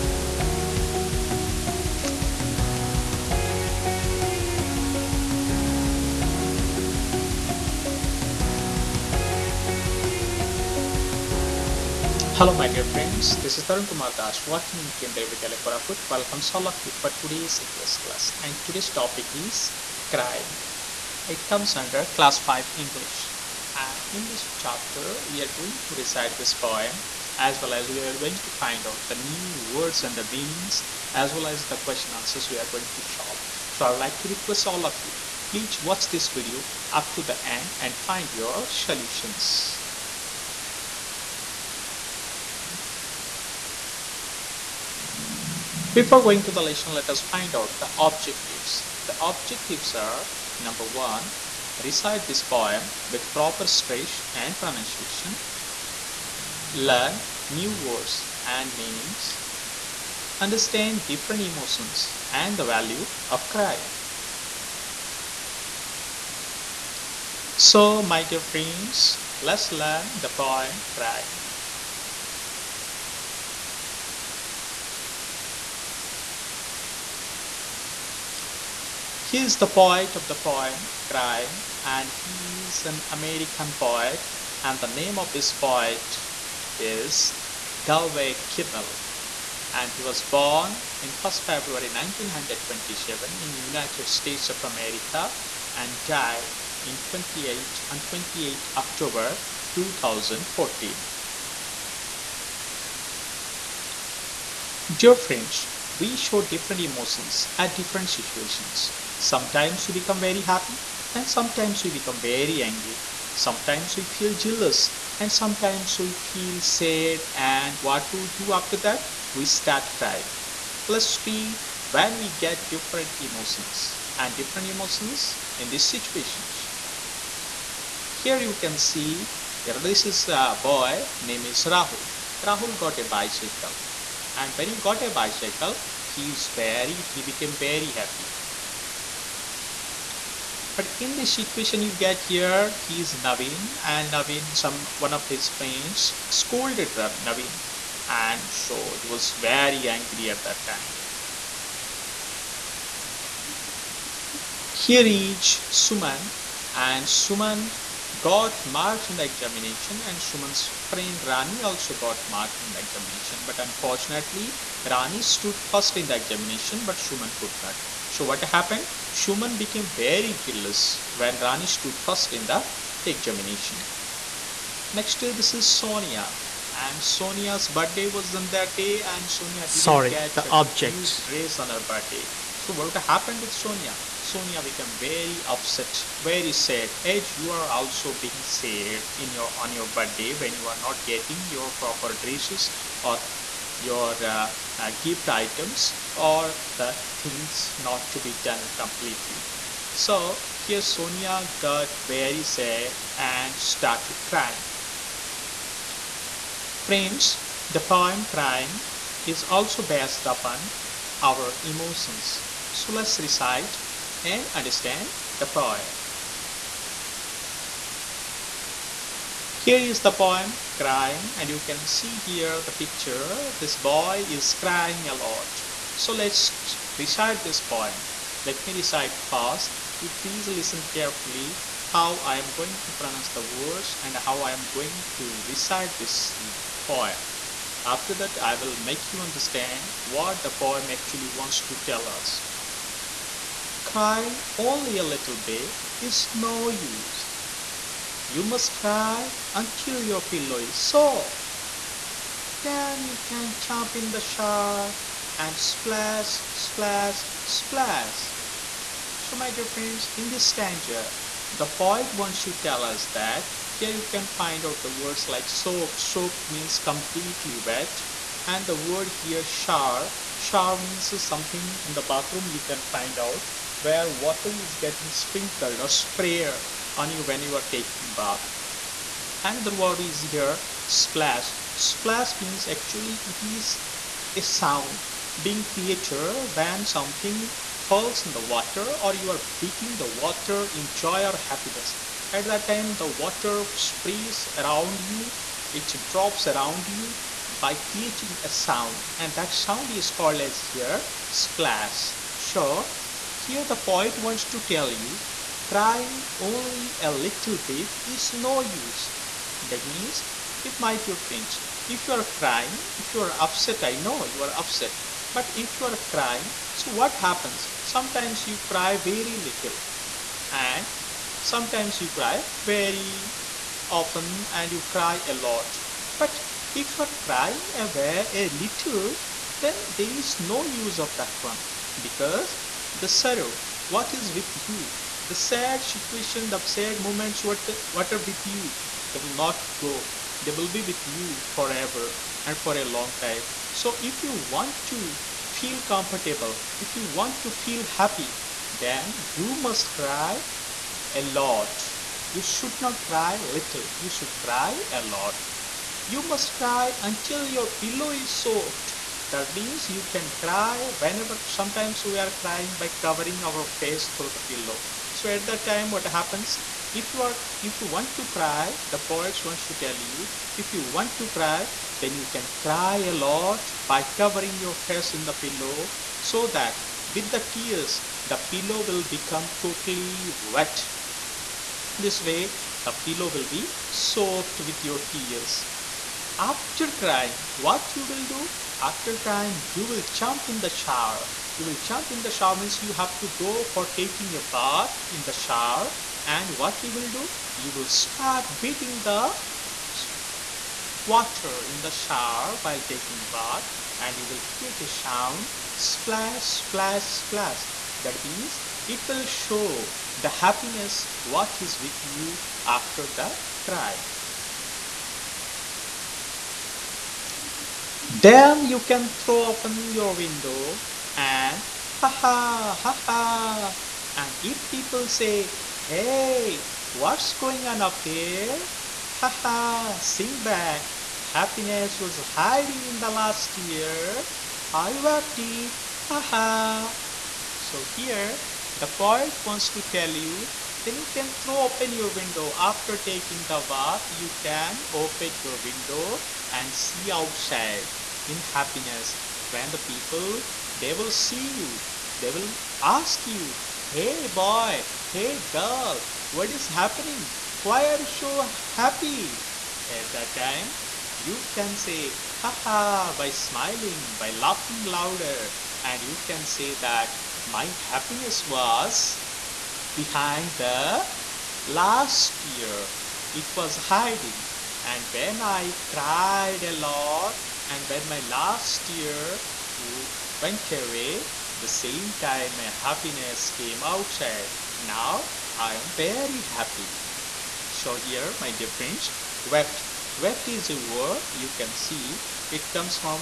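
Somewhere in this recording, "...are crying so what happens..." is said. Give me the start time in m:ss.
5:15.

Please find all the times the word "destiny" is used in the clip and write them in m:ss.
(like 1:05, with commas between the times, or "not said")
not said.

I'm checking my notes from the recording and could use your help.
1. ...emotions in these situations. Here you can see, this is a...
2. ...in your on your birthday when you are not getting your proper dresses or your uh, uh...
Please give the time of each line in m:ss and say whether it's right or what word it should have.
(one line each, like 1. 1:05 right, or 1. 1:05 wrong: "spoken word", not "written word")
1. 2:04 right
2. 3:09 right.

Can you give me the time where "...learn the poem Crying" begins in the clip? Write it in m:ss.
1:09.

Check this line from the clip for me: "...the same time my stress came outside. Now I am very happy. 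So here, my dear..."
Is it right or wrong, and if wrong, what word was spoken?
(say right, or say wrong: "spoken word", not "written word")
wrong: "happiness", not "stress".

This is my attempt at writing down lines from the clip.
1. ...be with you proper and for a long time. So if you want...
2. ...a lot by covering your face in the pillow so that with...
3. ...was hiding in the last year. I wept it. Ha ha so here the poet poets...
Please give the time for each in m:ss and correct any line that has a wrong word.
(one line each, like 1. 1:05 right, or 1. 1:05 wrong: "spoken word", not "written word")
1. 5:40 wrong: "forever", not "proper"
2. 6:12 right
3. 7:11 wrong: "wants", not "poets".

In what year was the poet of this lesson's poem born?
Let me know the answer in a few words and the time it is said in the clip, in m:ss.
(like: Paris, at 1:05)
1927, at 1:31.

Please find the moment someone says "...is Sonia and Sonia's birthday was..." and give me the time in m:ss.
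2:55.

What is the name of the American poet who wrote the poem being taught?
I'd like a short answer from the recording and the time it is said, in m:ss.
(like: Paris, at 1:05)
Galway Kinnell, at 1:27.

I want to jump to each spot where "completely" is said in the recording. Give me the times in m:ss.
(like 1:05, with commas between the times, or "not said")
3:18, 4:26.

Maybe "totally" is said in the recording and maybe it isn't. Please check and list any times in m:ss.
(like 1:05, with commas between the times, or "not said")
6:19.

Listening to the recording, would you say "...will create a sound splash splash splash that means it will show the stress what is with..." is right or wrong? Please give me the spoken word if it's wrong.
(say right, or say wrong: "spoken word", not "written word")
wrong: "happiness", not "stress".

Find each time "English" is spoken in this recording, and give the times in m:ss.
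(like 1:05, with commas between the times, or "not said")
0:17, 0:22.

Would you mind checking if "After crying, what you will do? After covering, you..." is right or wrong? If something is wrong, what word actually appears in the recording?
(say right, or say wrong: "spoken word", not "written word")
wrong: "crying", not "covering".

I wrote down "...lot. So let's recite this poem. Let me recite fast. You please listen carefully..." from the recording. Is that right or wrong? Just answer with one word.
right.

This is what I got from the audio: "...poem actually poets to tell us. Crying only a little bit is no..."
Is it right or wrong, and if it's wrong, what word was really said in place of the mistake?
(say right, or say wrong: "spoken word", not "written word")
wrong: "wants", not "poets".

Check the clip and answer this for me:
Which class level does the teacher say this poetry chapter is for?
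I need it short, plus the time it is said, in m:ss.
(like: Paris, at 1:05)
Class 5, at 0:22.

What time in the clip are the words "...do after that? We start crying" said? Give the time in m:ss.
1:58.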